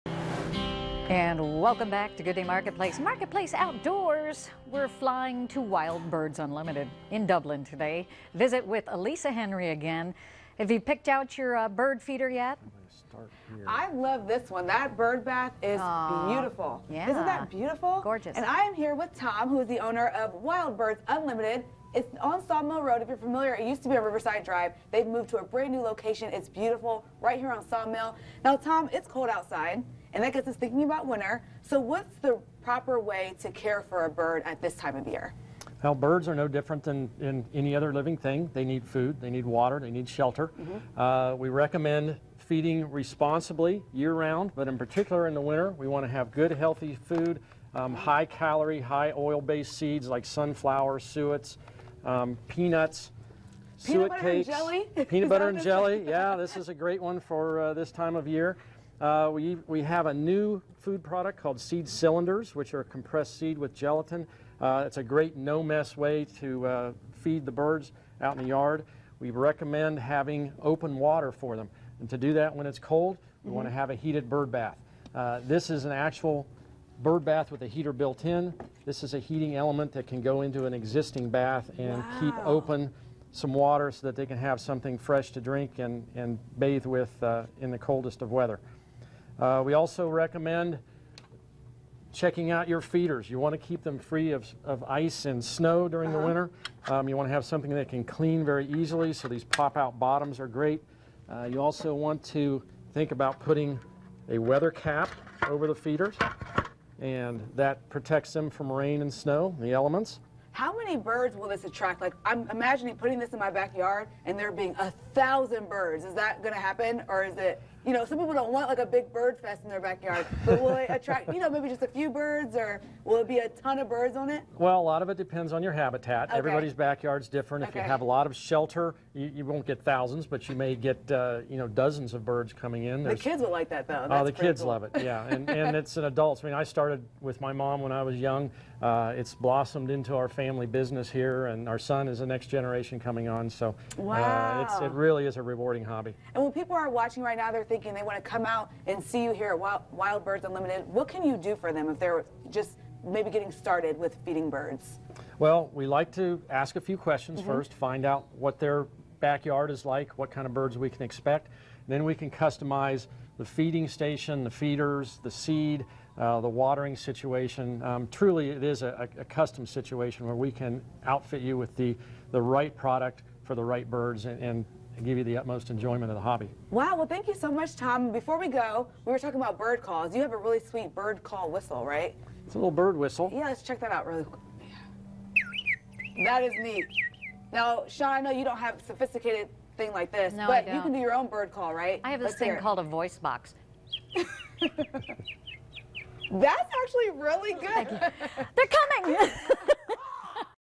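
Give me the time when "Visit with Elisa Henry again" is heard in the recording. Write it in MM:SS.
00:08.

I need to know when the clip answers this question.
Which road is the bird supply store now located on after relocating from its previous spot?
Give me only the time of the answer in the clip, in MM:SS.
00:22.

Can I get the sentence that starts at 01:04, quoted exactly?
Uh, it's a great no mess way to uh, feed the birds out in the yard.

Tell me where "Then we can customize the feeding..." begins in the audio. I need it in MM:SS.
02:41.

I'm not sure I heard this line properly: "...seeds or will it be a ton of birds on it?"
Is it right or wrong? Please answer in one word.
wrong.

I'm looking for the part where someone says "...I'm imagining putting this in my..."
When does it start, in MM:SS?
01:52.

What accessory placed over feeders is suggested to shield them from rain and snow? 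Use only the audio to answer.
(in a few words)
Weather cap.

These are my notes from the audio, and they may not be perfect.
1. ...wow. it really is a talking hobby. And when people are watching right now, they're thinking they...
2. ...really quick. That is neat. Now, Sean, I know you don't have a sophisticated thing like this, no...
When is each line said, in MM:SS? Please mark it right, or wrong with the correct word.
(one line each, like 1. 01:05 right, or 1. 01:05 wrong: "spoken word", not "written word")
1. 02:24 wrong: "rewarding", not "talking"
2. 03:04 right.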